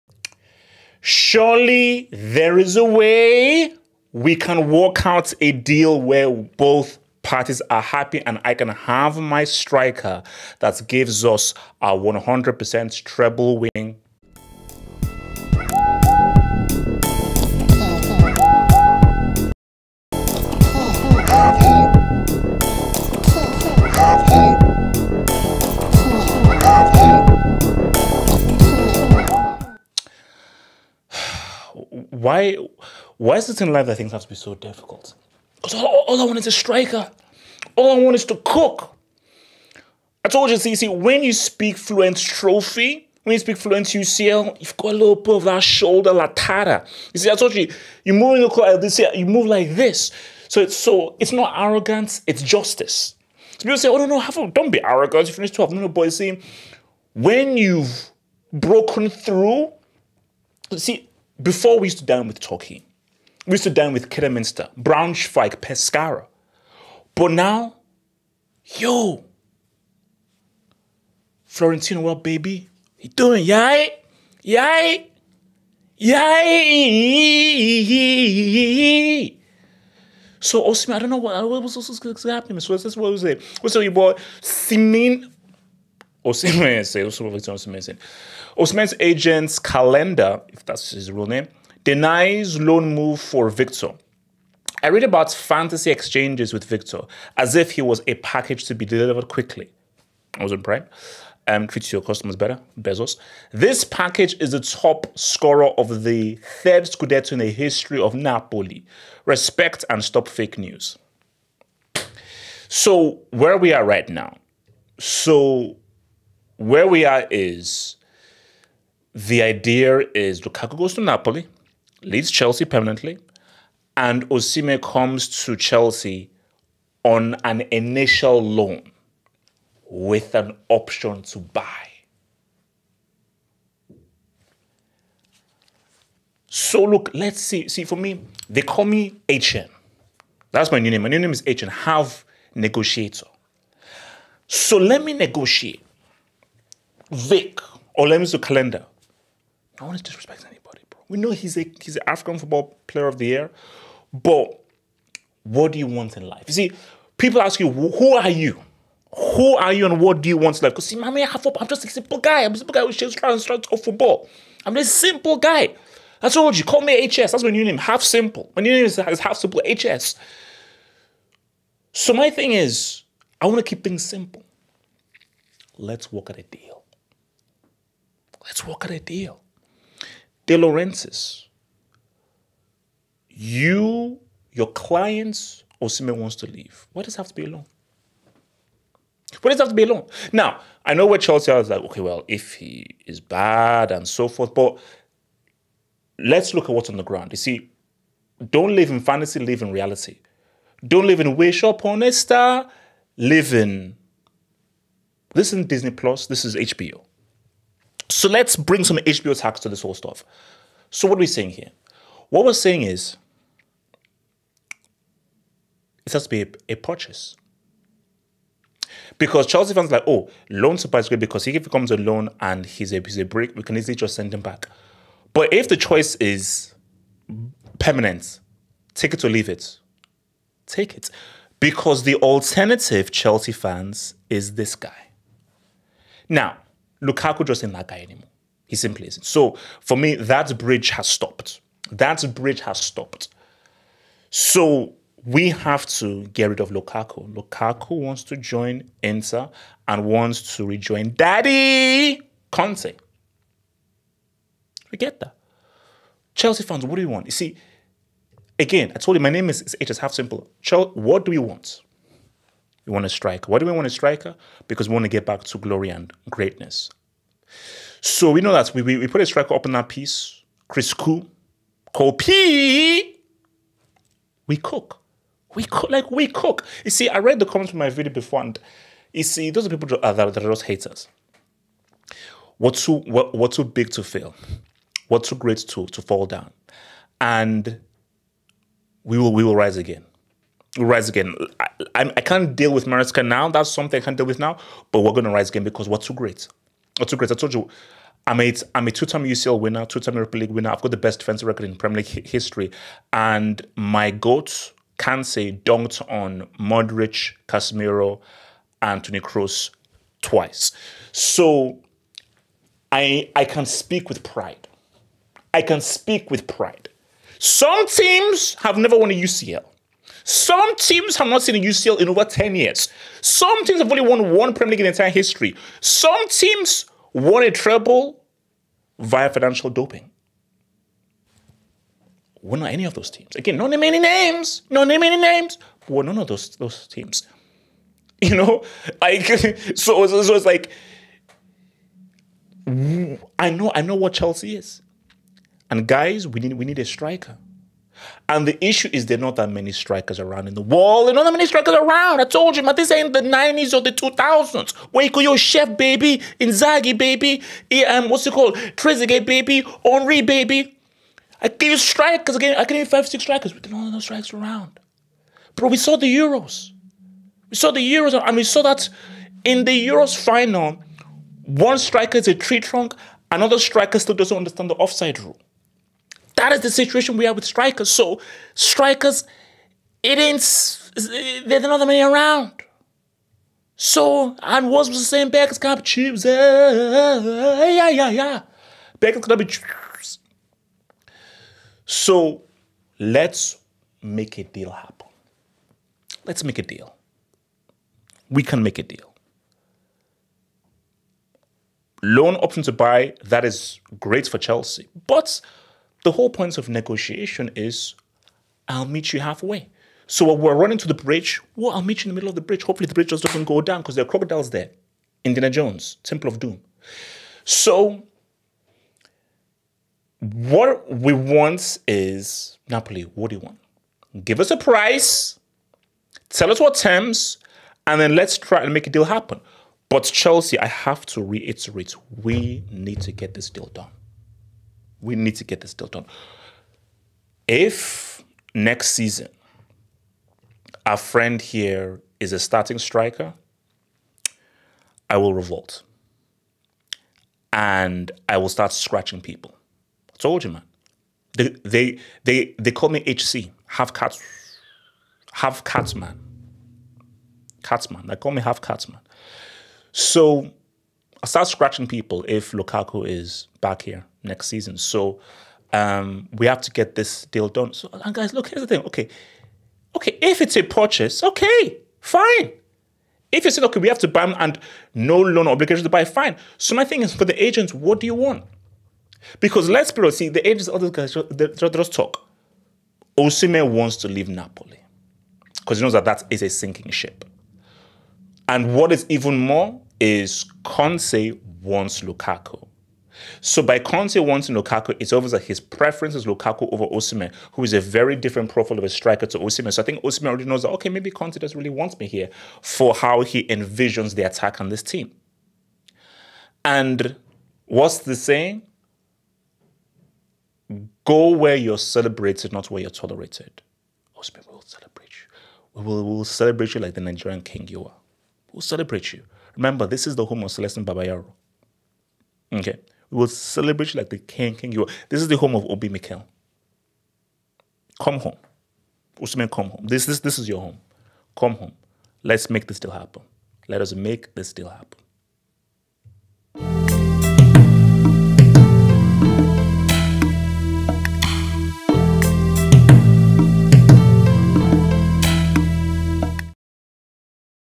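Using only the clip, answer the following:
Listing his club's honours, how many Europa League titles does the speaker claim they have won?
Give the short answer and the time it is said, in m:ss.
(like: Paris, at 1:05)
2, at 4:59.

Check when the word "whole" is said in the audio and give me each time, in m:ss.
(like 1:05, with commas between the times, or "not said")
3:29, 6:46.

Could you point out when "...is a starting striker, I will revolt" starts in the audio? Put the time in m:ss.
7:22.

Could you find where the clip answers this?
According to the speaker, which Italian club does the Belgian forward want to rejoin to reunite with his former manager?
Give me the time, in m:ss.
4:09.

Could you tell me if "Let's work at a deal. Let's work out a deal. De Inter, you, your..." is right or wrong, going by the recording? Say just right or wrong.
wrong.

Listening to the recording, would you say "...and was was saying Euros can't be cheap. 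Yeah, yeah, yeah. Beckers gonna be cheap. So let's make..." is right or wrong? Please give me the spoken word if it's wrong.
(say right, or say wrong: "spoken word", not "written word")
wrong: "Beckers", not "Euros".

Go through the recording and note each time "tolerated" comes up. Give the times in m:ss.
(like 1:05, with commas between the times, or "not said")
8:32.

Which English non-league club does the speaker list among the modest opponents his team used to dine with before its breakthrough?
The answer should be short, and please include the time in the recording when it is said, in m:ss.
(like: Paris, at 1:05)
Kidderminster, at 1:04.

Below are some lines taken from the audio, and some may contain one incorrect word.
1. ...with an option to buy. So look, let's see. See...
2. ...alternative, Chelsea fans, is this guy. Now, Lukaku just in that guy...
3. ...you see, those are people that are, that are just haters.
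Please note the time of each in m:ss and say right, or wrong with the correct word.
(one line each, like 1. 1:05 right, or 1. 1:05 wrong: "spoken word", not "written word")
1. 2:09 right
2. 3:52 right
3. 4:39 right.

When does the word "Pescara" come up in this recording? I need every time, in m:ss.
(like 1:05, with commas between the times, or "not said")
1:05.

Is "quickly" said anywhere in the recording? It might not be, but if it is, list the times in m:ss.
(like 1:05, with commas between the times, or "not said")
1:39.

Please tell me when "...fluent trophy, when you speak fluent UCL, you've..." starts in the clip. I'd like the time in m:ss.
0:41.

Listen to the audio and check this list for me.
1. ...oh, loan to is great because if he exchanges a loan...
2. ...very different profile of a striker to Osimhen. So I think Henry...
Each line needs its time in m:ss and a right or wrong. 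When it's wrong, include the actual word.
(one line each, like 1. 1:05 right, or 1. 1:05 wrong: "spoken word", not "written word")
1. 3:40 wrong: "comes", not "exchanges"
2. 8:17 wrong: "Osimhen", not "Henry".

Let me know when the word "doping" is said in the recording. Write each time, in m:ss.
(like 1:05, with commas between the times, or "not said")
5:29.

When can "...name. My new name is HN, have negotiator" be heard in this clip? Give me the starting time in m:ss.
2:20.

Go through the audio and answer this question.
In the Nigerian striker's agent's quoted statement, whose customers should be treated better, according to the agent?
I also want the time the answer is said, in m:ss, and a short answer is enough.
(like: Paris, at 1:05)
Bezos, at 1:42.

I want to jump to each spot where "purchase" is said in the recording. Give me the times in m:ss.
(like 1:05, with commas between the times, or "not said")
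3:36, 7:50.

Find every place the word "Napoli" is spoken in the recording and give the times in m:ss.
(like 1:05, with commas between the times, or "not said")
1:48, 2:01, 7:02, 8:04.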